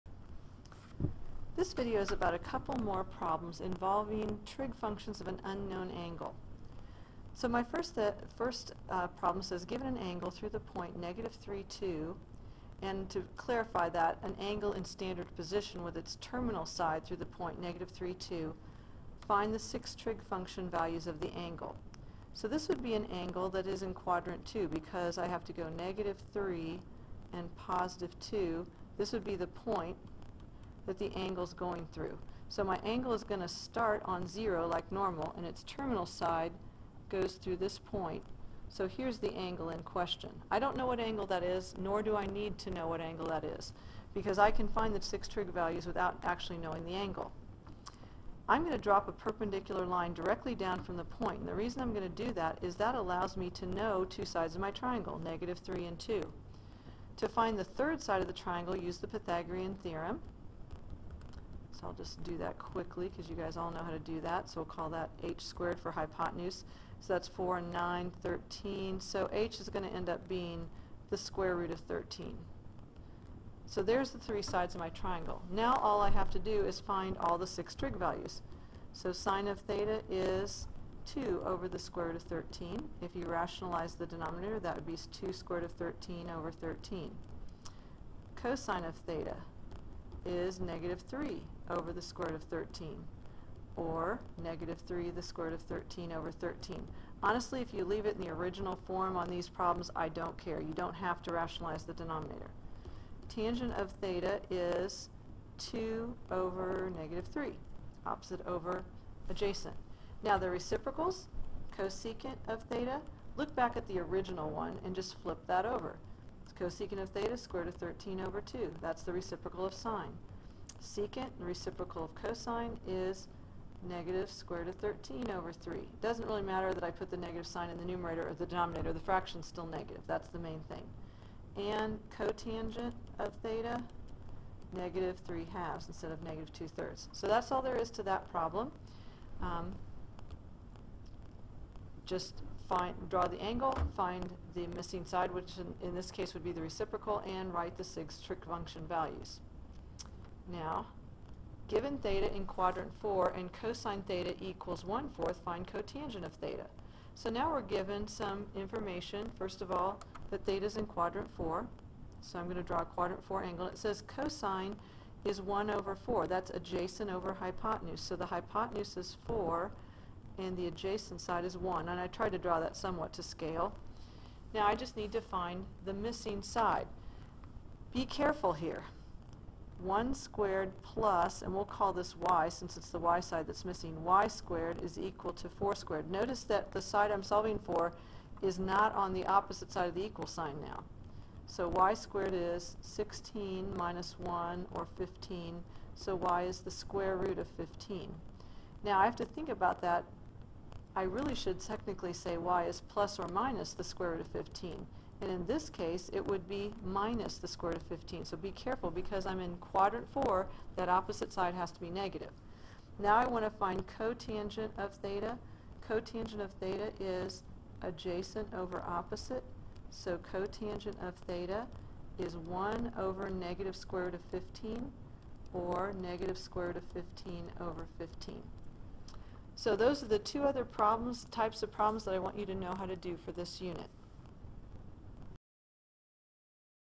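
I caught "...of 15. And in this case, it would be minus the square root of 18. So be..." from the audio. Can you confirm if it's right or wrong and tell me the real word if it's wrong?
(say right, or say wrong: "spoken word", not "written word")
wrong: "15", not "18".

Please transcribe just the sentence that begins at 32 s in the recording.
So my angle is going to start on zero like normal, and its terminal side goes through this point.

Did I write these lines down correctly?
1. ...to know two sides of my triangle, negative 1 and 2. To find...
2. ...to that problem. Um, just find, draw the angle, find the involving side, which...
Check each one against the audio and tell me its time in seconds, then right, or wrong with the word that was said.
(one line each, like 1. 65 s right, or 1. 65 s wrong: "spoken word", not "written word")
1. 53 s wrong: "3", not "1"
2. 137 s wrong: "missing", not "involving".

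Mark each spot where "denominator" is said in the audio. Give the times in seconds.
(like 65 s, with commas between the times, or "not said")
84 s, 101 s, 128 s.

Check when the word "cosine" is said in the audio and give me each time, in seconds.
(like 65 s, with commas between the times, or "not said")
88 s, 122 s, 153 s, 164 s.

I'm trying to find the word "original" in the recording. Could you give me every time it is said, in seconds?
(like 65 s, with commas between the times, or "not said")
98 s, 113 s.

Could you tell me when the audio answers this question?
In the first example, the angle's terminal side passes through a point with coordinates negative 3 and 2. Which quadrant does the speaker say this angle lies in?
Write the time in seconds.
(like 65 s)
23 s.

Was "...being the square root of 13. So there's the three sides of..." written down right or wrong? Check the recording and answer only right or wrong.
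right.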